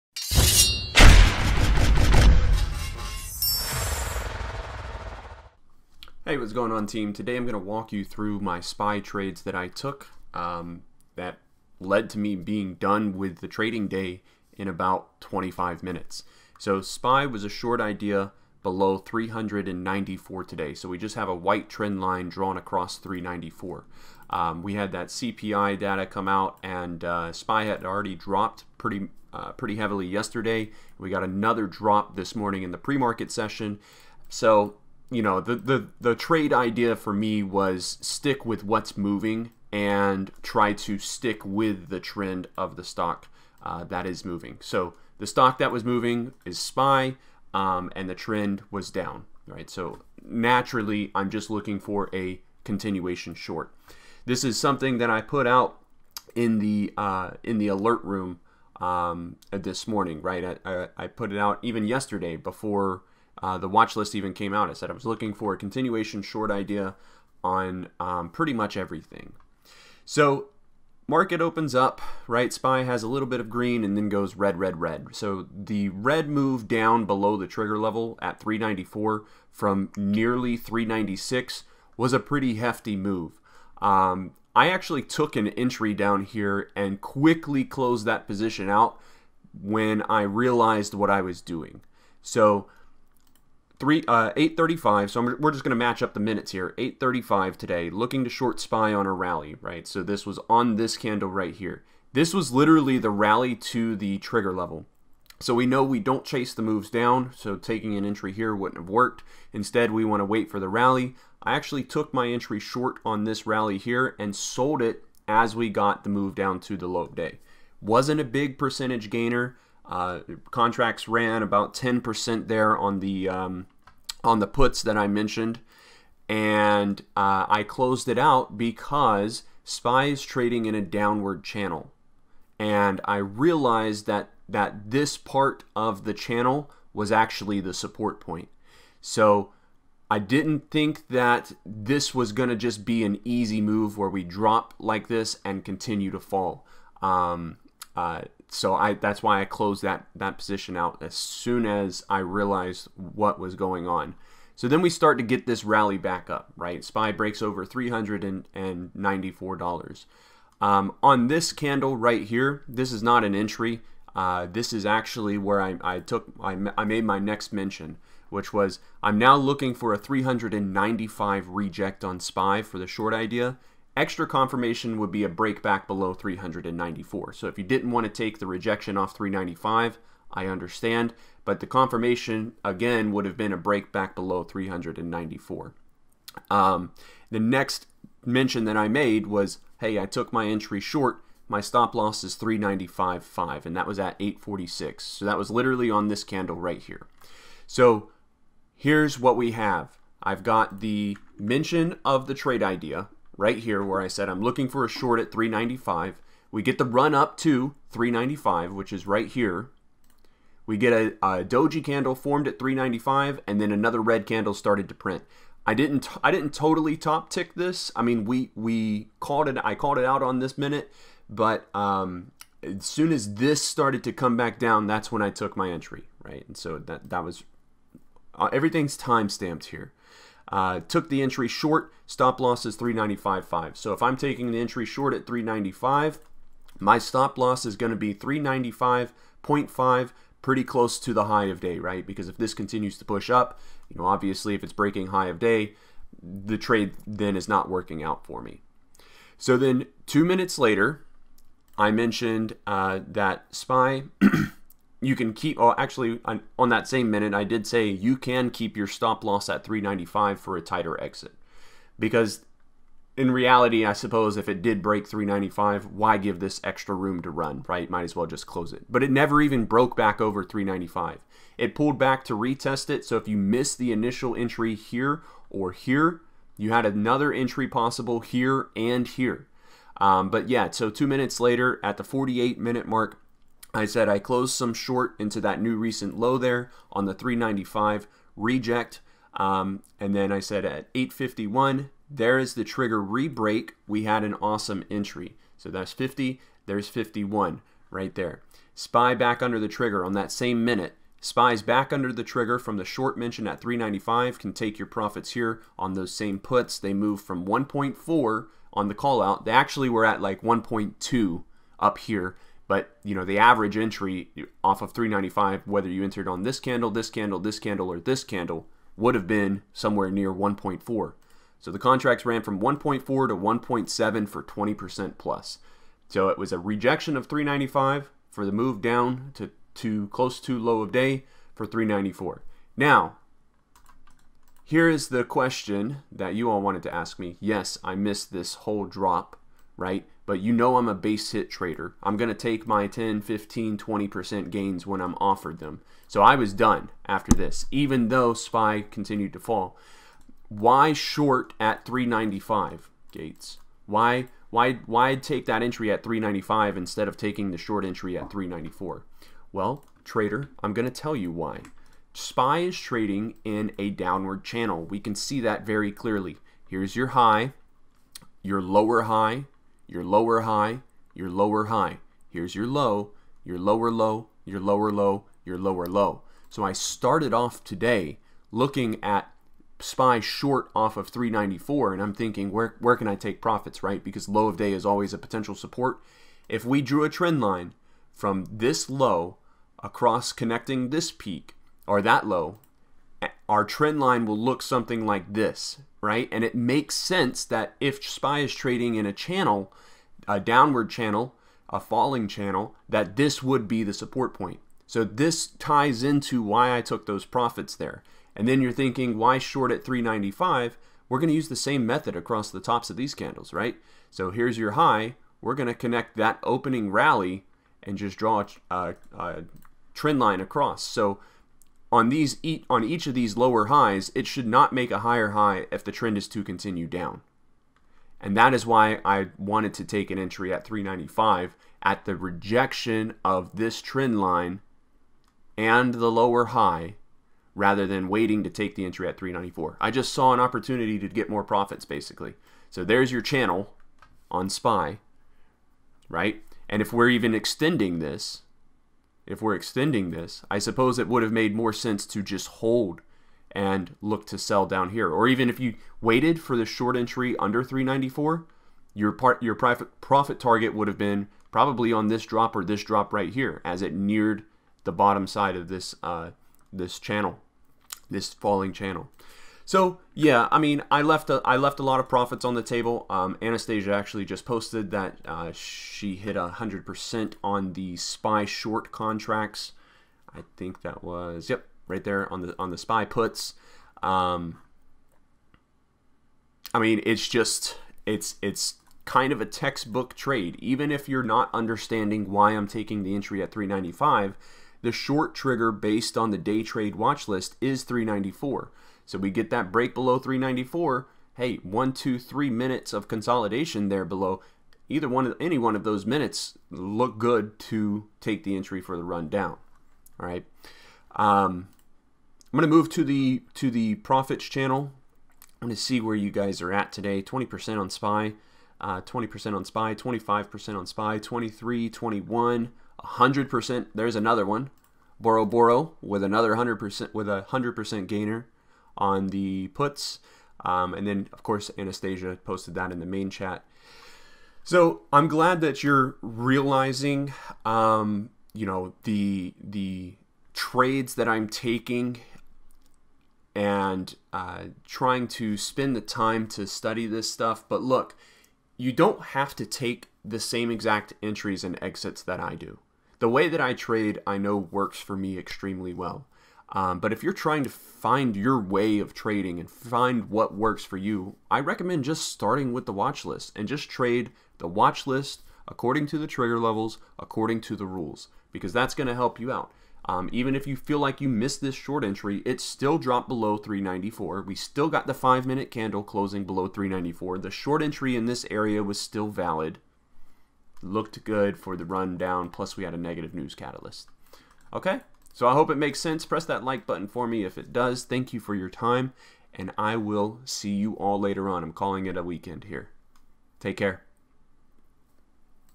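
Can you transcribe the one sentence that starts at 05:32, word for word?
Now, here is the question that you all wanted to ask me.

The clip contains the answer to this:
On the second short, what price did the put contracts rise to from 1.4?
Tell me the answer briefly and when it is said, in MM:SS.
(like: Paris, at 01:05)
1.7, at 05:22.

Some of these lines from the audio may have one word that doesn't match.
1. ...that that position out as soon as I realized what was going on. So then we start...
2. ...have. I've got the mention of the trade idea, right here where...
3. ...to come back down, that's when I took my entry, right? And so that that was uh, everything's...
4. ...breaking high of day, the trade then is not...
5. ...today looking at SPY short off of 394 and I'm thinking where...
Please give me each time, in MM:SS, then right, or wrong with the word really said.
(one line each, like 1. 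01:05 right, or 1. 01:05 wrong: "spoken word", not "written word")
1. 02:29 right
2. 03:19 right
3. 03:44 right
4. 04:04 right
5. 06:17 right.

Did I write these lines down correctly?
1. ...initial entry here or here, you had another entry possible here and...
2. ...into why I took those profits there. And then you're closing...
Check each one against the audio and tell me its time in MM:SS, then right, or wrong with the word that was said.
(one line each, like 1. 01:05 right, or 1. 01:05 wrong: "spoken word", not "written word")
1. 04:33 right
2. 06:46 wrong: "thinking", not "closing".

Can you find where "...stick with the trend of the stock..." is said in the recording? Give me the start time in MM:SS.
00:40.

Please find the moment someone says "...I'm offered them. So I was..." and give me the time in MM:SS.
05:45.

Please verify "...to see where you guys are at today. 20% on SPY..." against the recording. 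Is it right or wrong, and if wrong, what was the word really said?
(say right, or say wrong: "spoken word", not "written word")
right.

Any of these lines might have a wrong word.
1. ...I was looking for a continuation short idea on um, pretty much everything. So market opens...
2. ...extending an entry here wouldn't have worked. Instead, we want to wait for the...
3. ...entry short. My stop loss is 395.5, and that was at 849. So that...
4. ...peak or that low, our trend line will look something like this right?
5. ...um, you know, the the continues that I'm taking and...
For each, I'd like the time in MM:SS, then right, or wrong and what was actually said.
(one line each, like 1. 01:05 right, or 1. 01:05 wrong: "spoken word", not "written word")
1. 01:04 right
2. 01:47 wrong: "taking", not "extending"
3. 03:10 wrong: "846", not "849"
4. 06:31 right
5. 08:57 wrong: "trades", not "continues".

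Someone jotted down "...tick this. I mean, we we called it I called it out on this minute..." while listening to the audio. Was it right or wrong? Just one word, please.
right.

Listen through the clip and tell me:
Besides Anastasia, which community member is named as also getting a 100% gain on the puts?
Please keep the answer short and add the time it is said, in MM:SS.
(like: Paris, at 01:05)
Boro, at 08:45.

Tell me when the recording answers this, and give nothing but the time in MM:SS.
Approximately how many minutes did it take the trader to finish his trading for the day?
00:15.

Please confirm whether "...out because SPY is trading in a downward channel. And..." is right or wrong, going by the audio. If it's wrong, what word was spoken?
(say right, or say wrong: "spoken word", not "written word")
right.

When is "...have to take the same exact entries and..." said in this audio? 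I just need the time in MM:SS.
09:09.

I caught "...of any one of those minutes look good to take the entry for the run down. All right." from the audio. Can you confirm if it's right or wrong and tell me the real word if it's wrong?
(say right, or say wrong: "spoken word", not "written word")
right.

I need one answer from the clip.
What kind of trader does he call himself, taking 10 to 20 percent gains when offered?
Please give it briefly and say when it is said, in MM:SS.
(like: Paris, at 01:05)
base hit trader, at 05:40.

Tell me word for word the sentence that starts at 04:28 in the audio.
But it never even broke back over 395.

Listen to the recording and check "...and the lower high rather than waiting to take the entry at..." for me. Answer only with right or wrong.
right.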